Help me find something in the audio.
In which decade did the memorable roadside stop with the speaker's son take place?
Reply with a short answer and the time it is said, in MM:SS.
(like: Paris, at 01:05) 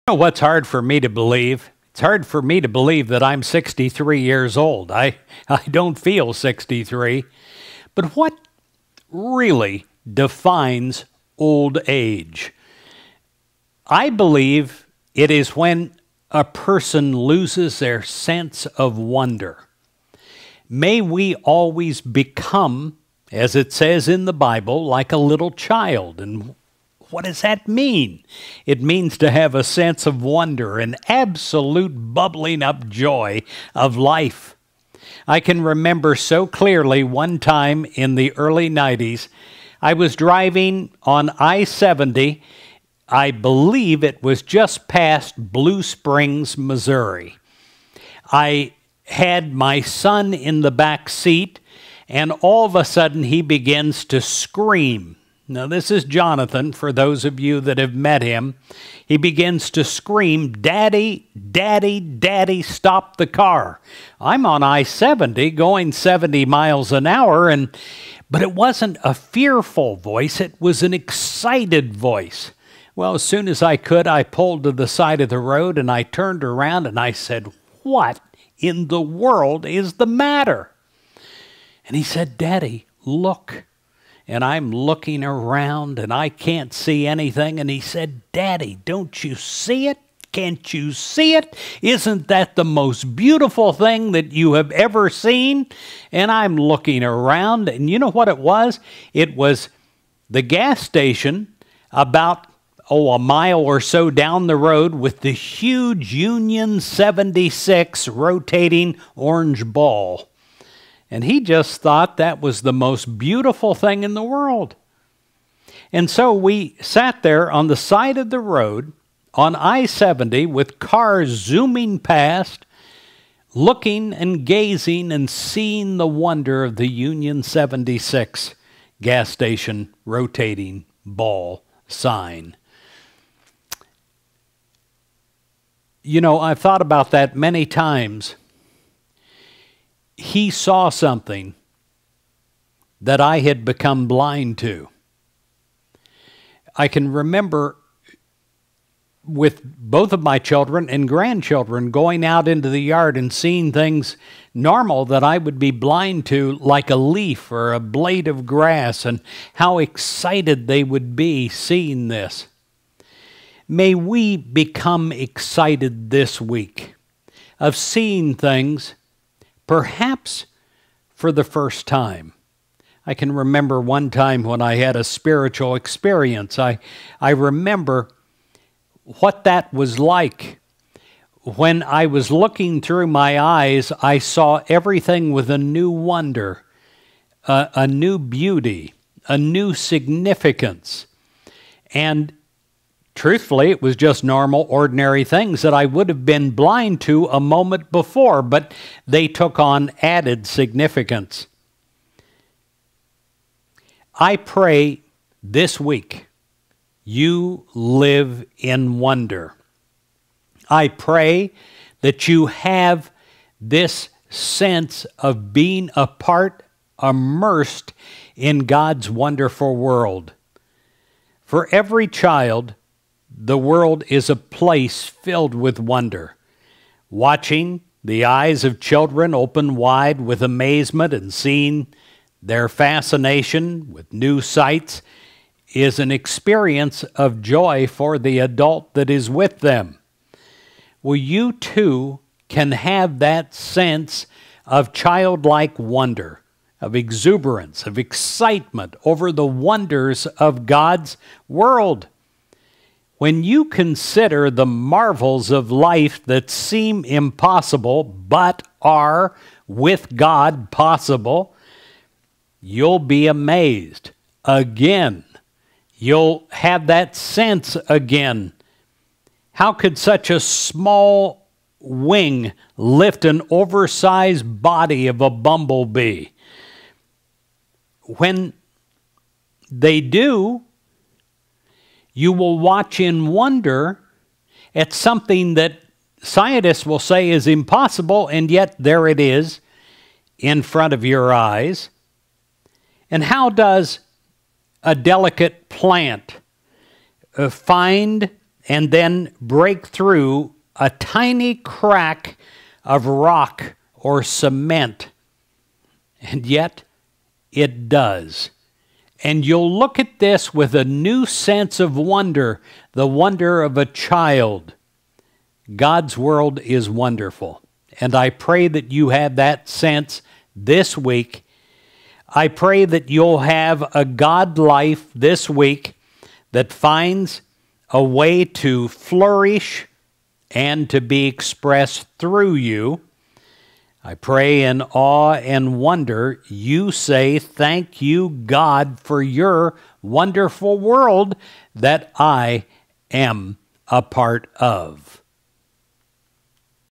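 Early 90s, at 00:38.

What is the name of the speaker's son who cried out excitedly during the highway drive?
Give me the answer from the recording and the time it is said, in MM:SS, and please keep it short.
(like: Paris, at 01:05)
Jonathan, at 00:56.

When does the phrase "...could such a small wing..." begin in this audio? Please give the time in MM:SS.
04:29.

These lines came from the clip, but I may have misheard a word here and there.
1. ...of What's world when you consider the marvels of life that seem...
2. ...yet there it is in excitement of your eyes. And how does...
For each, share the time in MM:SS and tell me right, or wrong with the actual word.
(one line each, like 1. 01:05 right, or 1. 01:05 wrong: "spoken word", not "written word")
1. 04:10 wrong: "God", not "What"
2. 04:48 wrong: "front", not "excitement".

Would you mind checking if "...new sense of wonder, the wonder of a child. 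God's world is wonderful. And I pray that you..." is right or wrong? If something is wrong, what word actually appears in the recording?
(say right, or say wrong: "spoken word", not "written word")
right.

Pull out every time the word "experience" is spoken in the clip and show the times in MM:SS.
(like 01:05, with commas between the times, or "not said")
02:55, 03:56.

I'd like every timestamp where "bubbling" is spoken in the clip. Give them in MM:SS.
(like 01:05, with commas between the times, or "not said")
00:32.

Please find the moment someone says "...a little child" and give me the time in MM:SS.
00:25.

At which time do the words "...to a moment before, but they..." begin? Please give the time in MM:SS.
03:17.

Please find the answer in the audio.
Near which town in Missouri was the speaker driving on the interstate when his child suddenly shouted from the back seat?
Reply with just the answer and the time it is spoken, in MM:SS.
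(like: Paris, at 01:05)
Blue Springs, at 00:45.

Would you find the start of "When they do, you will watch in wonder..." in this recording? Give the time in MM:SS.
04:38.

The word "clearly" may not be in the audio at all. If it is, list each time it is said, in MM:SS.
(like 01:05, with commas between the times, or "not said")
00:36.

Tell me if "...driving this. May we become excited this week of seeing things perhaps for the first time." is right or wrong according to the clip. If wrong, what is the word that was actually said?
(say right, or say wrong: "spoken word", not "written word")
wrong: "seeing", not "driving".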